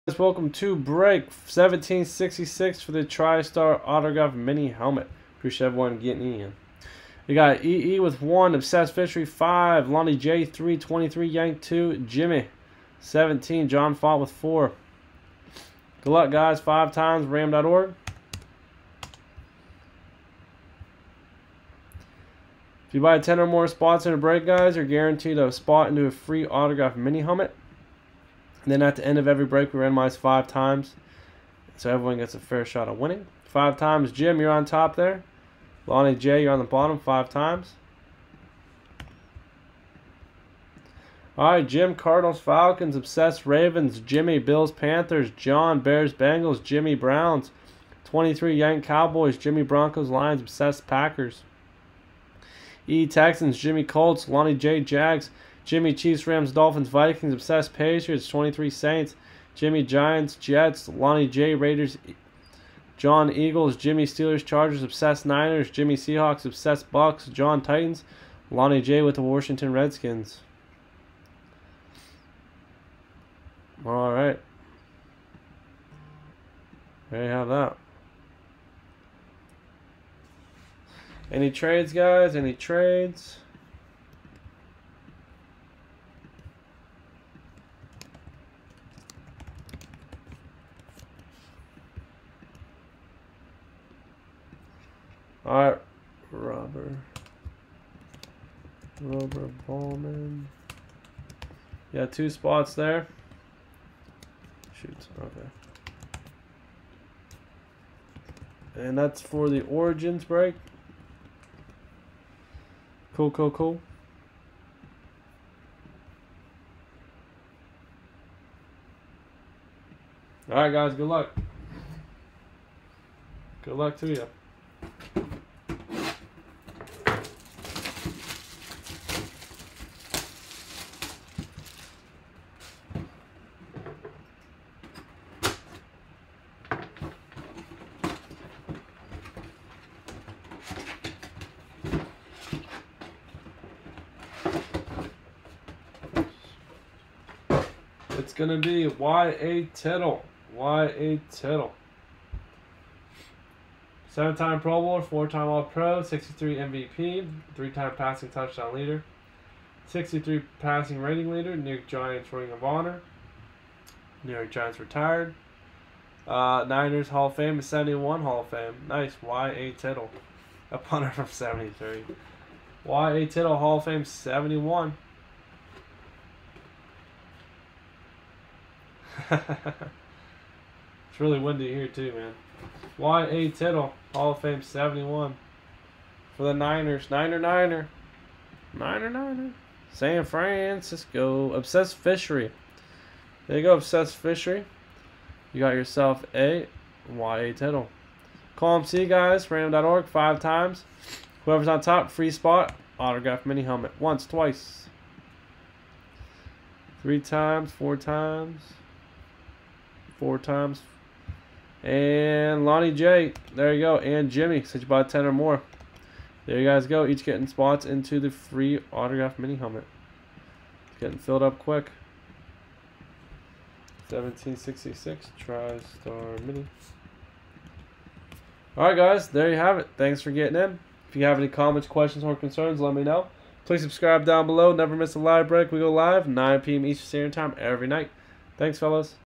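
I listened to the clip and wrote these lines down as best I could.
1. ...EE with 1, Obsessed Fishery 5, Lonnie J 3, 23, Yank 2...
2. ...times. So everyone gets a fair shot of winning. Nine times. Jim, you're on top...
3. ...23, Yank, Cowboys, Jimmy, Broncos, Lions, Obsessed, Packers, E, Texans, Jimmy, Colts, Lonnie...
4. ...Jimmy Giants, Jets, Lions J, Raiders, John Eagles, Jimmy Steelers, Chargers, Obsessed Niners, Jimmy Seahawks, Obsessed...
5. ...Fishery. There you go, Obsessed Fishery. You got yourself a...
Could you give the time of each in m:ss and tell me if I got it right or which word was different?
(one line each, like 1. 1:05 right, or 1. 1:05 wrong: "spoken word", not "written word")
1. 0:07 right
2. 0:30 wrong: "Five", not "Nine"
3. 0:48 right
4. 0:59 wrong: "Lonnie", not "Lions"
5. 3:11 right.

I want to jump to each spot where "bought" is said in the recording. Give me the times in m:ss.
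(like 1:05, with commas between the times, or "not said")
3:34.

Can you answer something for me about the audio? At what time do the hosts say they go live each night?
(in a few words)
9 p.m. Eastern.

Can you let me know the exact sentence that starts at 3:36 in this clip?
There you guys go, each getting spots into the free autograph mini helmet.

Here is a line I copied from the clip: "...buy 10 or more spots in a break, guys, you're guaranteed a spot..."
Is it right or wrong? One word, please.
right.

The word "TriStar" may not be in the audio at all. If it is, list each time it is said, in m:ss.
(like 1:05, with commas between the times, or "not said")
0:03, 3:45.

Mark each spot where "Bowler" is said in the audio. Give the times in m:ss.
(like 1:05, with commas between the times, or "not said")
2:34.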